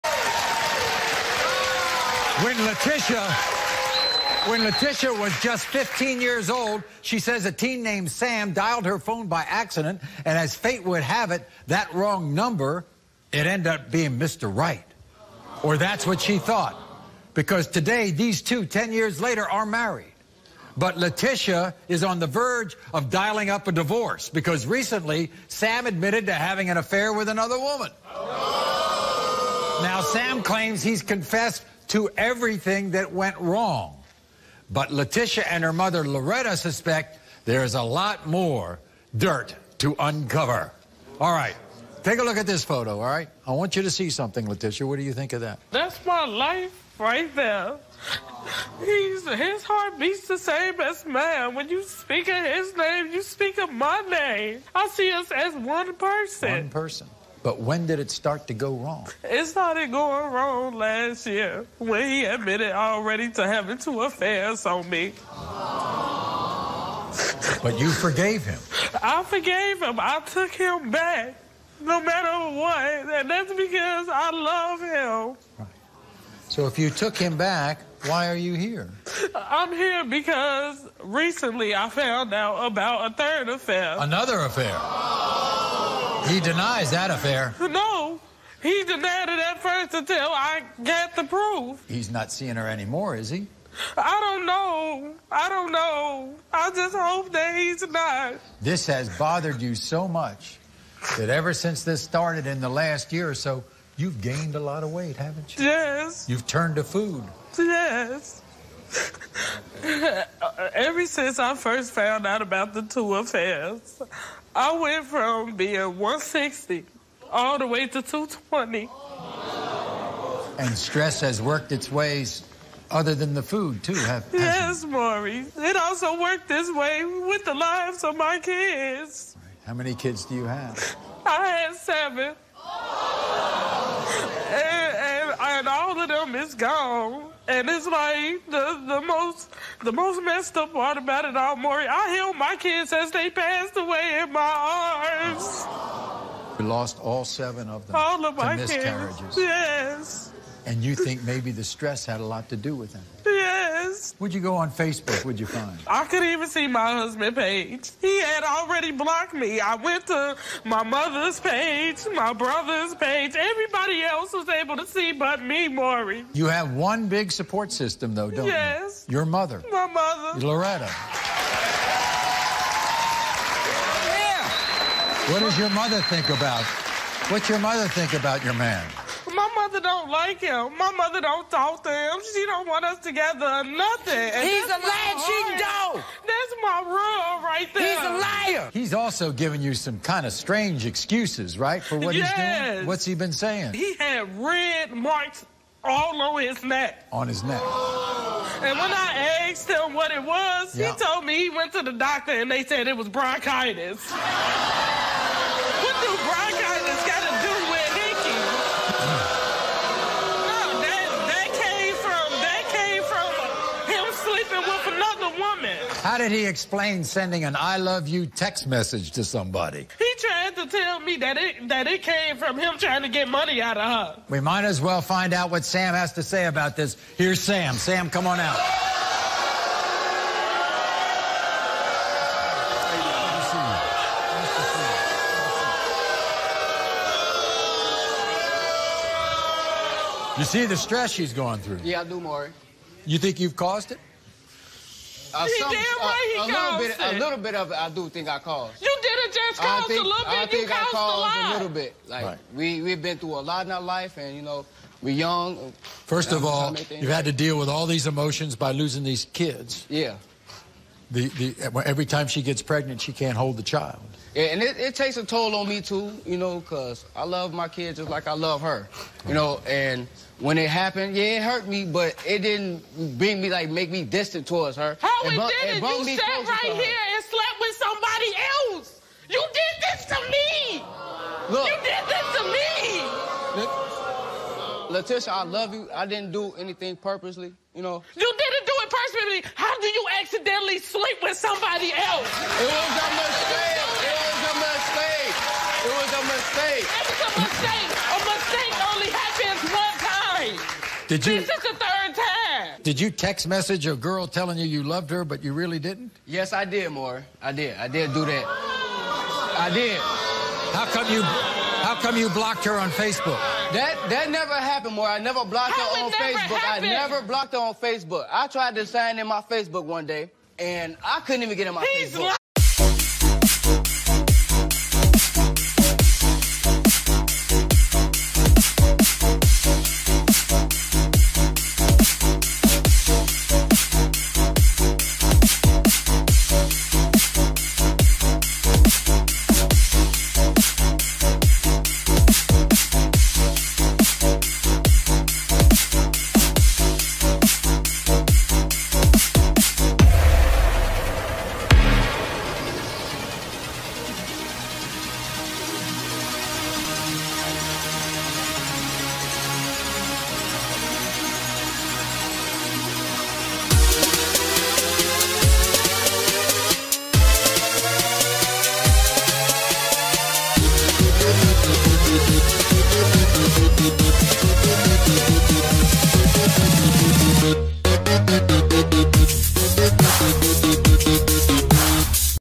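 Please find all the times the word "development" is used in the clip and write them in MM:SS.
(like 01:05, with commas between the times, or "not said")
not said.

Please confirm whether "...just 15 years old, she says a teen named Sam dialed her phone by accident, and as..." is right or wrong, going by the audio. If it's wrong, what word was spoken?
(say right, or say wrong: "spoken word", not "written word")
right.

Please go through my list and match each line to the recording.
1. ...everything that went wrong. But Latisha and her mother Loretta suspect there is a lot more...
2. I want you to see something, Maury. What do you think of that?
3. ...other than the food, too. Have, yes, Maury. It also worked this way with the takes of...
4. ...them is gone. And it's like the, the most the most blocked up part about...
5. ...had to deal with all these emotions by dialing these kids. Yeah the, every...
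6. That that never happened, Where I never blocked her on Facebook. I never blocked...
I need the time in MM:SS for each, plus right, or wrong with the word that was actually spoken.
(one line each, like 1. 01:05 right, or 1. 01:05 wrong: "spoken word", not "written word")
1. 00:32 right
2. 00:43 wrong: "Latisha", not "Maury"
3. 02:02 wrong: "lives", not "takes"
4. 02:16 wrong: "messed", not "blocked"
5. 04:17 wrong: "losing", not "dialing"
6. 05:13 right.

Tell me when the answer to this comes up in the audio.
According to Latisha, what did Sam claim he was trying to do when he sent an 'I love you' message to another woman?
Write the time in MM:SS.
03:43.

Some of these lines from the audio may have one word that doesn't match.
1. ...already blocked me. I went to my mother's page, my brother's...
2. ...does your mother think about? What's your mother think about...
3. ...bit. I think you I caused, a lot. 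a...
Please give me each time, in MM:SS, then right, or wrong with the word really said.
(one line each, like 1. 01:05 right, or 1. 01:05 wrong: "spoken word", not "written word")
1. 02:38 right
2. 02:55 right
3. 04:10 right.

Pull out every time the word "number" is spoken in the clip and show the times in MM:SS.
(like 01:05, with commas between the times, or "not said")
00:12.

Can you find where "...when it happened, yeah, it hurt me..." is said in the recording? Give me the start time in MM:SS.
04:30.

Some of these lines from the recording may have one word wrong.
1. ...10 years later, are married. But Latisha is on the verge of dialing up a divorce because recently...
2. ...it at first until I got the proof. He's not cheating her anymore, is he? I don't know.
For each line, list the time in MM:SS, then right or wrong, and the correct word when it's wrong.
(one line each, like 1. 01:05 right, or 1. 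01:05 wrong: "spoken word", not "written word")
1. 00:18 right
2. 01:29 wrong: "seeing", not "cheating".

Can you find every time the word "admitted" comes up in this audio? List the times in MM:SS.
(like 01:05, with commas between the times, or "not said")
00:25, 01:02.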